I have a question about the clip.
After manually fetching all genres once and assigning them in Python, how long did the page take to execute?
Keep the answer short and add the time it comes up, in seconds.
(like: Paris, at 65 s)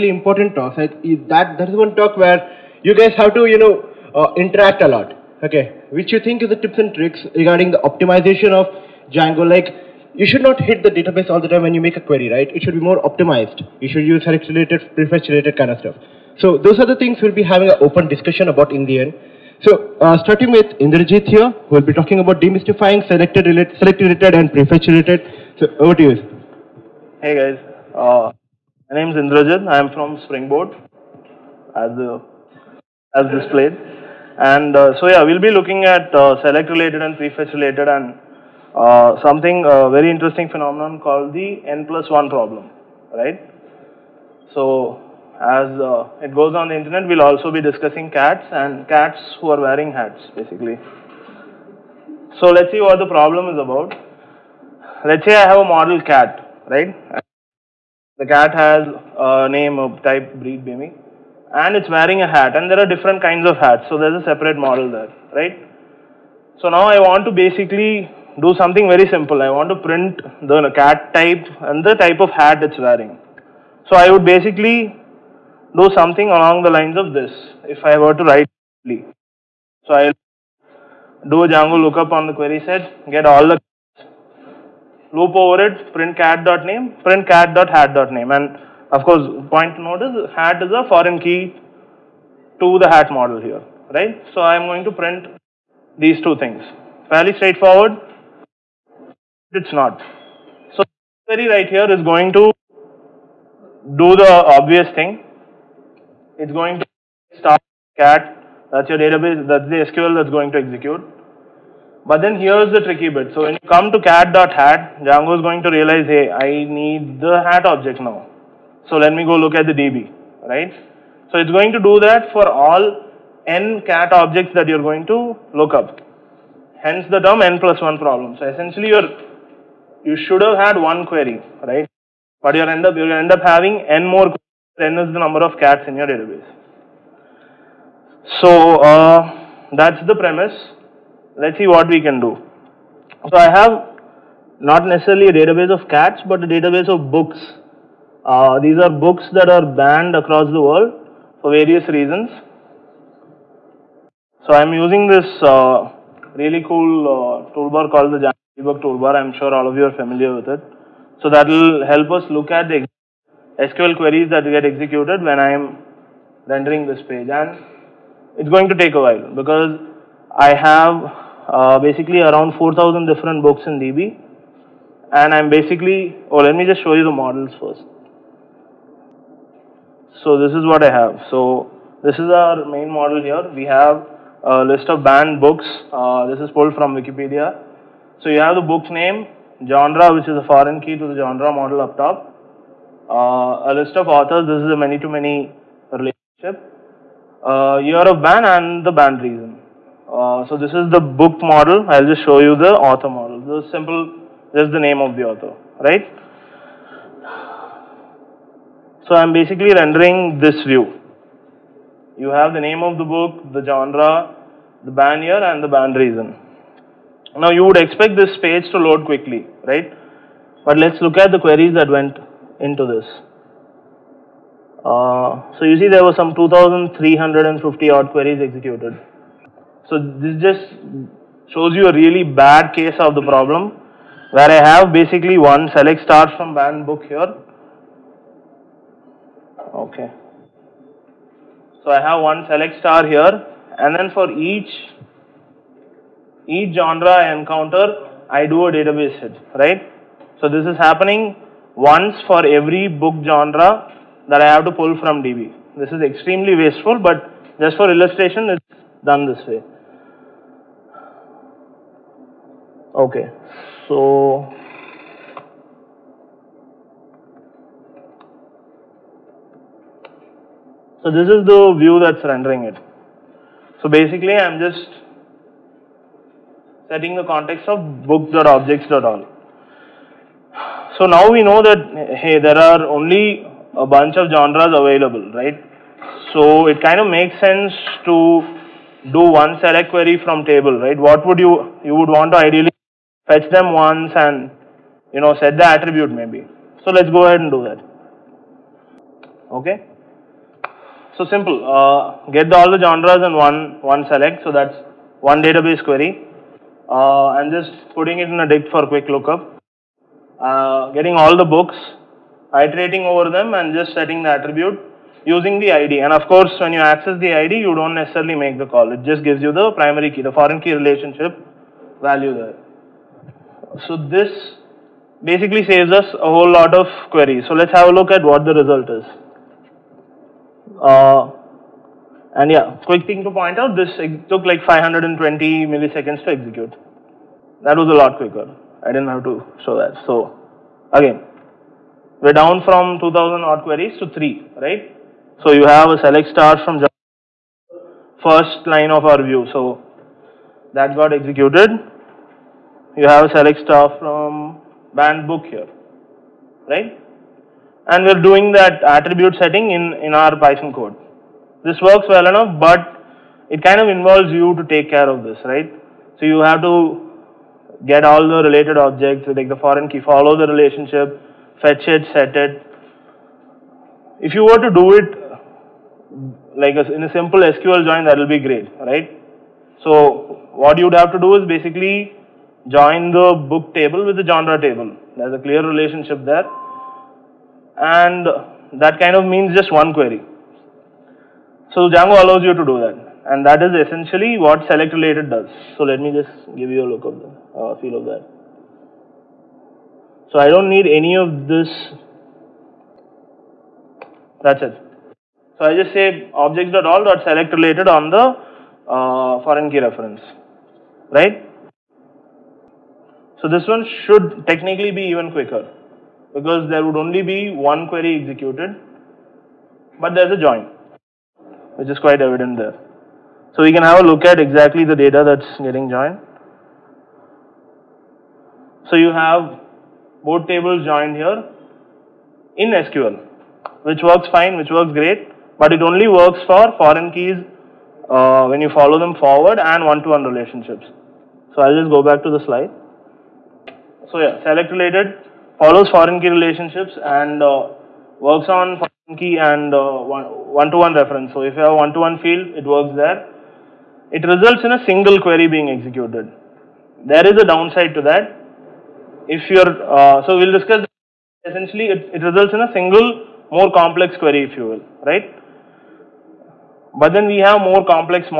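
520 milliseconds, at 334 s.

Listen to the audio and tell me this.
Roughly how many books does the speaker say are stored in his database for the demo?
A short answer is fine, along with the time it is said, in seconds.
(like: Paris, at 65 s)
4000, at 172 s.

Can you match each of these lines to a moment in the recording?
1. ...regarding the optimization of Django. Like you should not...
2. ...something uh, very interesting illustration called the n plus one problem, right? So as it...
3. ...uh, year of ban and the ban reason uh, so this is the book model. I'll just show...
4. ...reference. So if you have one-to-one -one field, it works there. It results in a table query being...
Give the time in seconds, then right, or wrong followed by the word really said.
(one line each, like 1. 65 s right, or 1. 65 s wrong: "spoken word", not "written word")
1. 7 s right
2. 39 s wrong: "phenomenon", not "illustration"
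3. 197 s right
4. 450 s wrong: "single", not "table".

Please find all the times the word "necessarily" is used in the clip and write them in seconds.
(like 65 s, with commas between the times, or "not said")
144 s, 317 s.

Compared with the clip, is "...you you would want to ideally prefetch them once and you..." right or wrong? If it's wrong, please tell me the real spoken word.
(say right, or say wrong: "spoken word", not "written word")
wrong: "fetch", not "prefetch".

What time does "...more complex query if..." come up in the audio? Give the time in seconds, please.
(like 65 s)
463 s.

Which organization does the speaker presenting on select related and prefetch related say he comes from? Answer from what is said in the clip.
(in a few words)
Springboard.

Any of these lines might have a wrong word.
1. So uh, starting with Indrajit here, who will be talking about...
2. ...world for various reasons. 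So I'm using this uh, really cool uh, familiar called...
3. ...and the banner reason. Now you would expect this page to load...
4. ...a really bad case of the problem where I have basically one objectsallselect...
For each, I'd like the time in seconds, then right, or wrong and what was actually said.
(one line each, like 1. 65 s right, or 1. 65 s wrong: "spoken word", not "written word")
1. 19 s right
2. 150 s wrong: "toolbar", not "familiar"
3. 215 s right
4. 231 s wrong: "select", not "objectsallselect".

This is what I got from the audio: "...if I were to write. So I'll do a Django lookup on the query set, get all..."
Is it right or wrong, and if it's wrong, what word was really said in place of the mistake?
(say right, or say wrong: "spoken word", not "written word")
right.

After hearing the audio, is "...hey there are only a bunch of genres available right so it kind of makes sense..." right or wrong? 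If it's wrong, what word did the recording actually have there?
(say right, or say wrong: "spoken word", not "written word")
right.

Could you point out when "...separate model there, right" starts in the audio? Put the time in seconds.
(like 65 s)
64 s.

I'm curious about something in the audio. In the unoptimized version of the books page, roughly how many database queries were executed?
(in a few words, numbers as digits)
2350.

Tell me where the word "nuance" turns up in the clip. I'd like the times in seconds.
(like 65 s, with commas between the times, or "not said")
not said.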